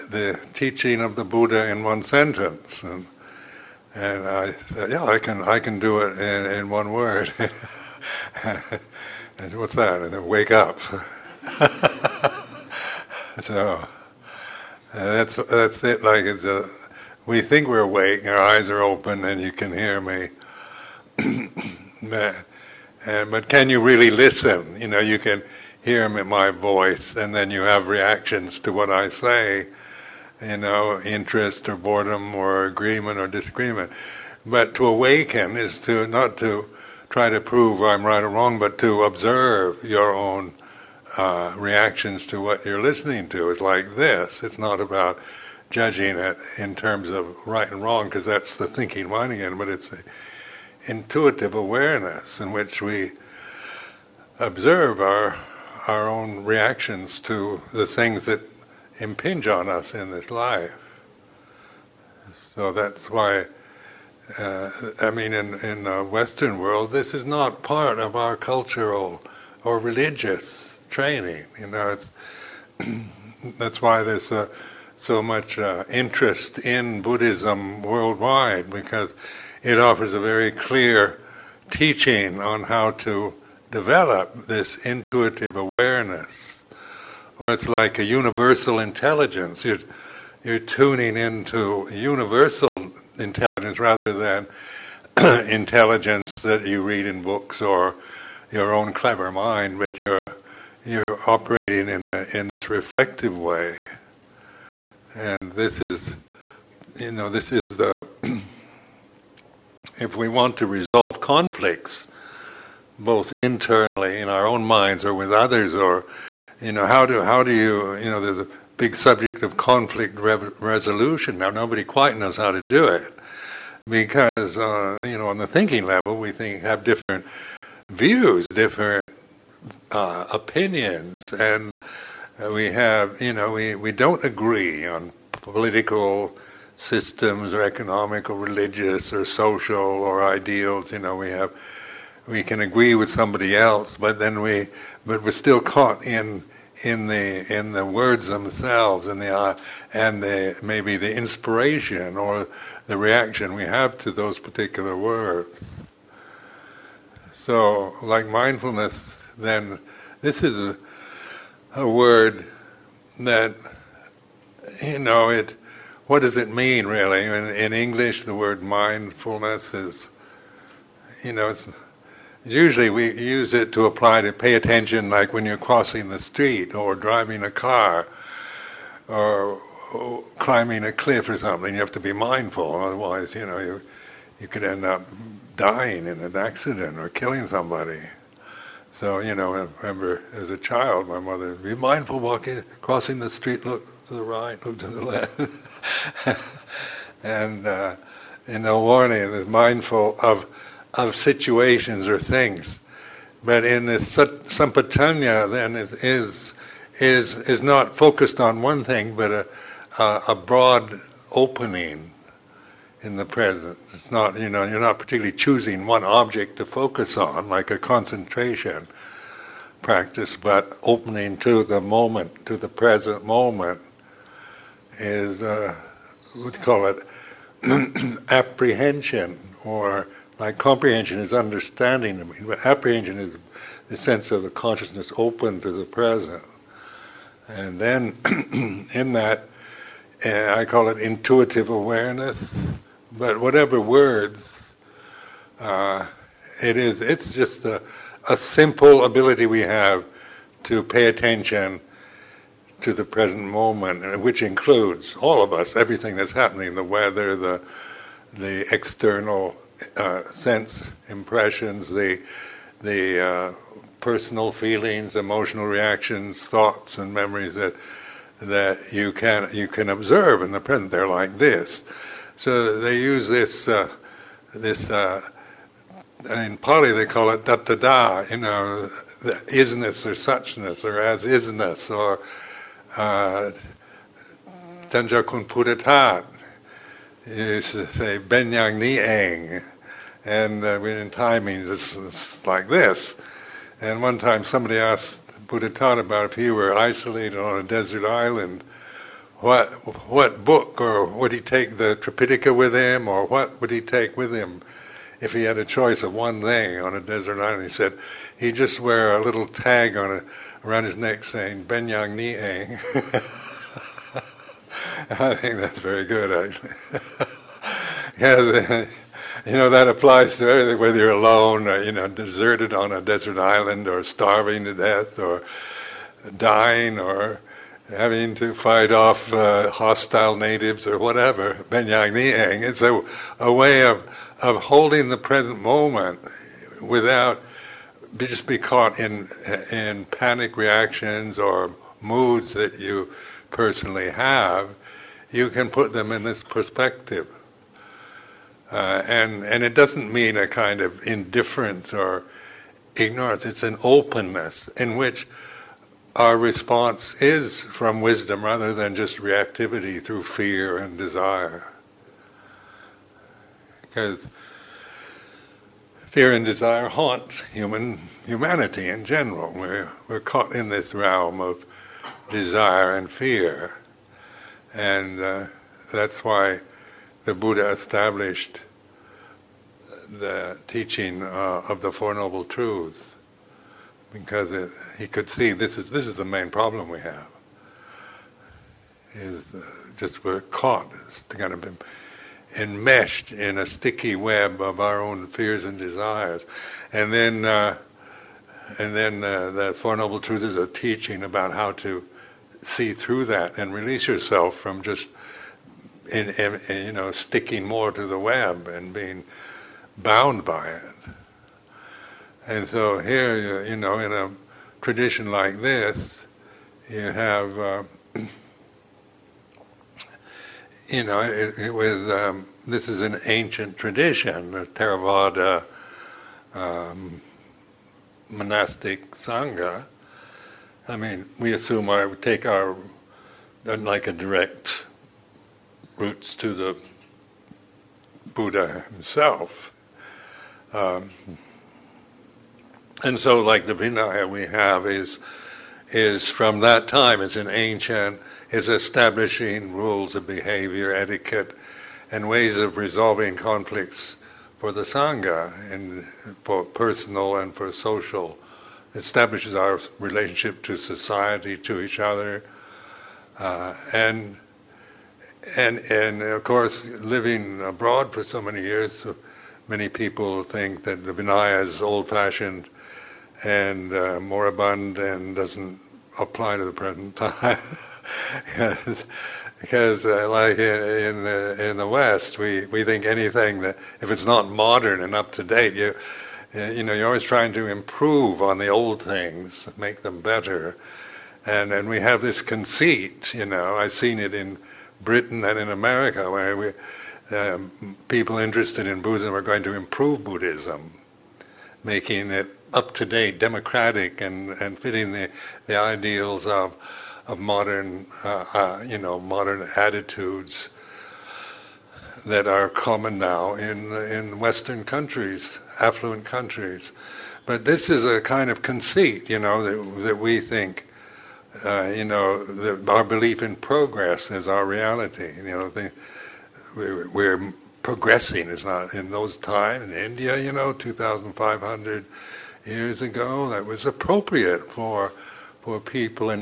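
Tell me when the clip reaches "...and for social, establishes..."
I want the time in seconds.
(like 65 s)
457 s.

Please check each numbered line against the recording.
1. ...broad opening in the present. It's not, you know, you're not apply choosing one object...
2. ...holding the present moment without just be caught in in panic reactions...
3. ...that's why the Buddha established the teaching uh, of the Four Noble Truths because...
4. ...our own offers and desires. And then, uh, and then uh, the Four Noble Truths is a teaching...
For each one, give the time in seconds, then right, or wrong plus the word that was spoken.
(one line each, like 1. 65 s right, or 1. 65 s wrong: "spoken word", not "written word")
1. 210 s wrong: "particularly", not "apply"
2. 334 s right
3. 375 s right
4. 394 s wrong: "fears", not "offers".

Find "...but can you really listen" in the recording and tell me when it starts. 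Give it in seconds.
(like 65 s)
23 s.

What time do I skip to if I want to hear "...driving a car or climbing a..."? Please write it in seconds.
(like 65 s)
176 s.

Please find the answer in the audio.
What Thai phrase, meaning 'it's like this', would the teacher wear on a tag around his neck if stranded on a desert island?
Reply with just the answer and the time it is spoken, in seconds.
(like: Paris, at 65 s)
Benyang Ni, at 311 s.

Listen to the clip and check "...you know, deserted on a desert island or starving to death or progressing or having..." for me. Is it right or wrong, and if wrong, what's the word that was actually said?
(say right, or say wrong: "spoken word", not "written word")
wrong: "dying", not "progressing".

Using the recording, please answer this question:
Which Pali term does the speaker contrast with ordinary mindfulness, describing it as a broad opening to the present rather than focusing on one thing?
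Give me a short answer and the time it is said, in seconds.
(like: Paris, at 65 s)
Sampajañña, at 204 s.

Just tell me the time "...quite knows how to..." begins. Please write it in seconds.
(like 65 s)
121 s.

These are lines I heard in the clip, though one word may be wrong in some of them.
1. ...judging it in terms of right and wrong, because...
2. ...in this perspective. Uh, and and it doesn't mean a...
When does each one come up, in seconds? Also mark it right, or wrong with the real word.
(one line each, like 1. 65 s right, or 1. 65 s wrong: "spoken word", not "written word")
1. 45 s right
2. 346 s right.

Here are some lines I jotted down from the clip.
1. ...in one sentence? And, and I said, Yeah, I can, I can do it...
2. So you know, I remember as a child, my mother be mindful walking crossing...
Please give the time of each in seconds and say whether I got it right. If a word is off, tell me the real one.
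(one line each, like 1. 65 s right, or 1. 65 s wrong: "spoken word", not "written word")
1. 1 s right
2. 188 s right.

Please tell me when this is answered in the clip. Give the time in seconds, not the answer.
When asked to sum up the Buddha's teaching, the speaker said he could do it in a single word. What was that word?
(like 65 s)
10 s.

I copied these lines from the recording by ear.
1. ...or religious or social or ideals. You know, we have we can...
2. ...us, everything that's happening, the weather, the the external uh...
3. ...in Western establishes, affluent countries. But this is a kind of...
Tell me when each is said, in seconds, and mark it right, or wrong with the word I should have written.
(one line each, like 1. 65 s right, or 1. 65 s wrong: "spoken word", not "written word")
1. 138 s right
2. 255 s right
3. 513 s wrong: "countries", not "establishes".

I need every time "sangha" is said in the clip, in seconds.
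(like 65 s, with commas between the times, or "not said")
429 s, 454 s.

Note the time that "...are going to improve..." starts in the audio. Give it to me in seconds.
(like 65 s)
499 s.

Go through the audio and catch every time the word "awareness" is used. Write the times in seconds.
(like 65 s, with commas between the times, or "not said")
51 s, 85 s, 241 s.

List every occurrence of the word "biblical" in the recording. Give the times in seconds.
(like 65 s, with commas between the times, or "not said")
not said.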